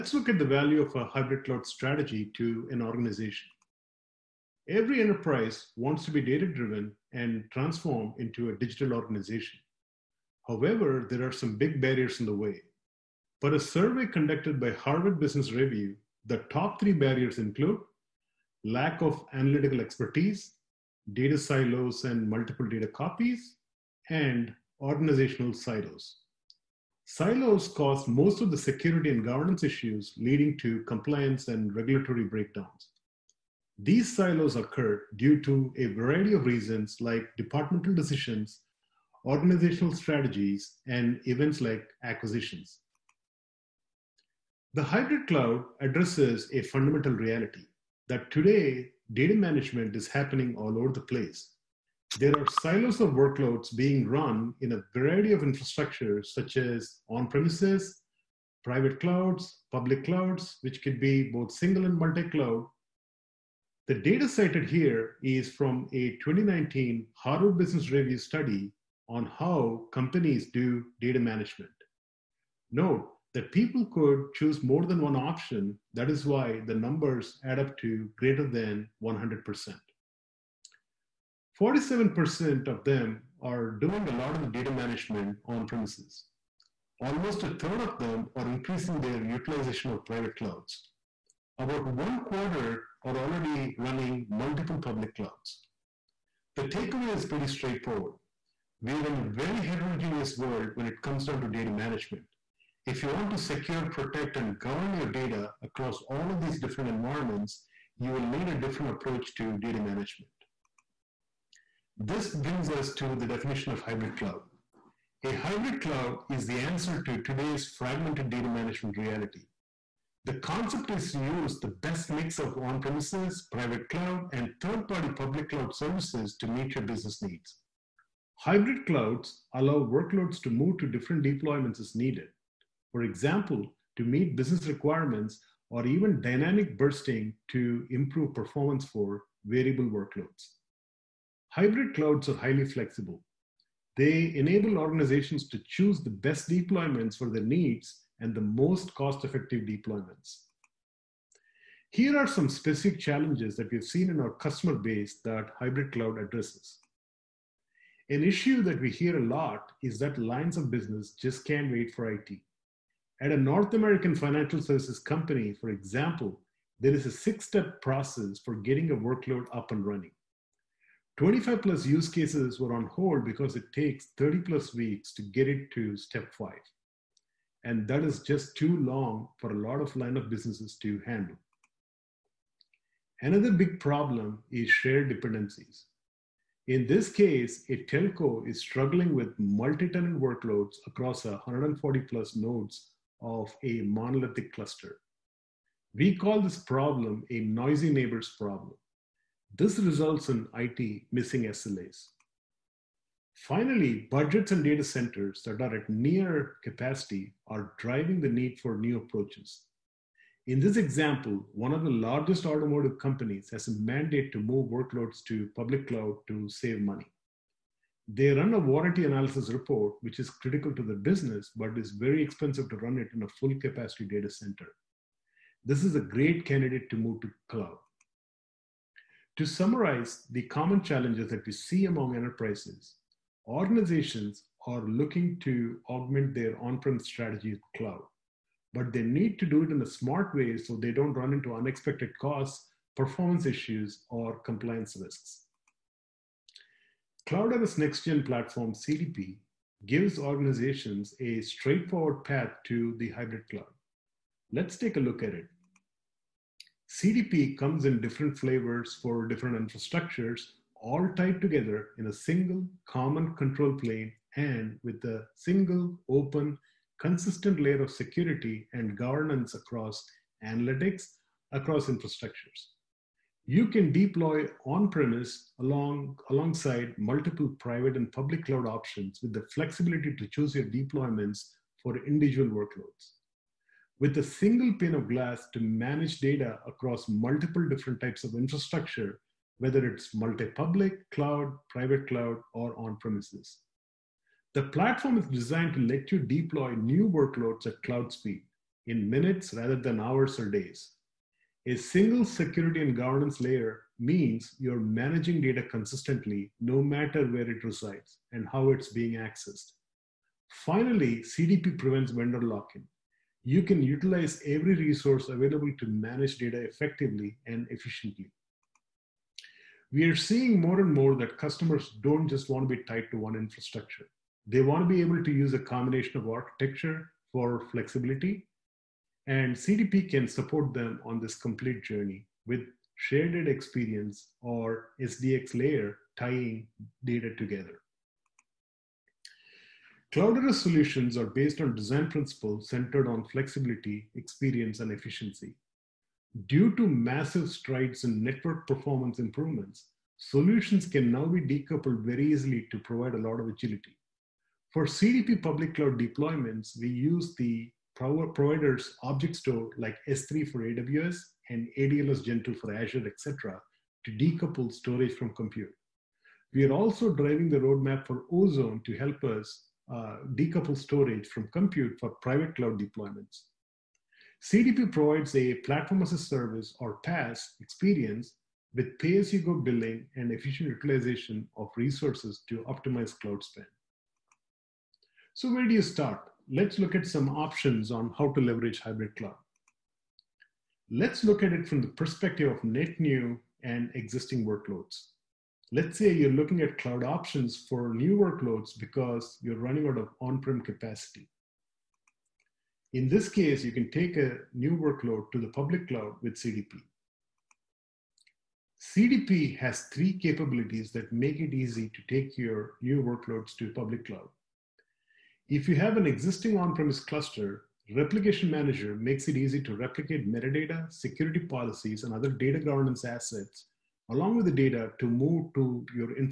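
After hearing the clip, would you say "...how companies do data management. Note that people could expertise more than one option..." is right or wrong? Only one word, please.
wrong.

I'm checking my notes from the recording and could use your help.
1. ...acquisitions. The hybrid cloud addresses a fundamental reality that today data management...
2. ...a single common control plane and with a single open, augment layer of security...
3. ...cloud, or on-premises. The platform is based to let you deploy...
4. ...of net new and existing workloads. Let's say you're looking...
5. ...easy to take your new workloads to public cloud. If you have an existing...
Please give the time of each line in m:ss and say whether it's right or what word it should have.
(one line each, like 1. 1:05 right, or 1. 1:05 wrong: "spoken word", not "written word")
1. 0:42 right
2. 4:22 wrong: "consistent", not "augment"
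3. 4:52 wrong: "designed", not "based"
4. 6:32 right
5. 6:51 right.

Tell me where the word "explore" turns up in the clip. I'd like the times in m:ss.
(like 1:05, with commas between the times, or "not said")
not said.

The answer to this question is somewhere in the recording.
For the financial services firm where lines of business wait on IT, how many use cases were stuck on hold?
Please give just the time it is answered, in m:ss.
2:51.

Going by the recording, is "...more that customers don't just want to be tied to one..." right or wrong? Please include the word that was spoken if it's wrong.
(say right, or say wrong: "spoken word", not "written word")
right.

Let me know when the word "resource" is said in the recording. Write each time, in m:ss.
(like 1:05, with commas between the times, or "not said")
5:14, 6:21.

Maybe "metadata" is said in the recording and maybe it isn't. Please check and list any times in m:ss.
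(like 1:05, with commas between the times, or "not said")
7:00.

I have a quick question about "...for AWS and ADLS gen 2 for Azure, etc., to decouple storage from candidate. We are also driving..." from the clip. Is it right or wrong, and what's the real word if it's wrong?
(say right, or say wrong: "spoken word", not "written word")
wrong: "compute", not "candidate".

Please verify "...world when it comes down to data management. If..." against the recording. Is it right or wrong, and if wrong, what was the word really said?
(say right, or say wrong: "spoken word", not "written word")
right.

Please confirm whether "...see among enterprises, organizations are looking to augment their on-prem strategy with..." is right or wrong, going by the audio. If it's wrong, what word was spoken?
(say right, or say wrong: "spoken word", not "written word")
right.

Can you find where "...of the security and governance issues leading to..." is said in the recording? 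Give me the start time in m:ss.
0:28.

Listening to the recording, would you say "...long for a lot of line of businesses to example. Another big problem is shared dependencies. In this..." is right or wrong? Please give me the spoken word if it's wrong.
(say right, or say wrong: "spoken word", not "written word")
wrong: "handle", not "example".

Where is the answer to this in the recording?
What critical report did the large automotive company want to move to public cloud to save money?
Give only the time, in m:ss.
3:38.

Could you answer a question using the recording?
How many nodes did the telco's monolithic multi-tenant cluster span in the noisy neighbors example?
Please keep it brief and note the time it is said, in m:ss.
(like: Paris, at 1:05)
140 plus, at 3:11.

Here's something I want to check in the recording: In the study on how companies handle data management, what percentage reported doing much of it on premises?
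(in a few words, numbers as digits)
47%.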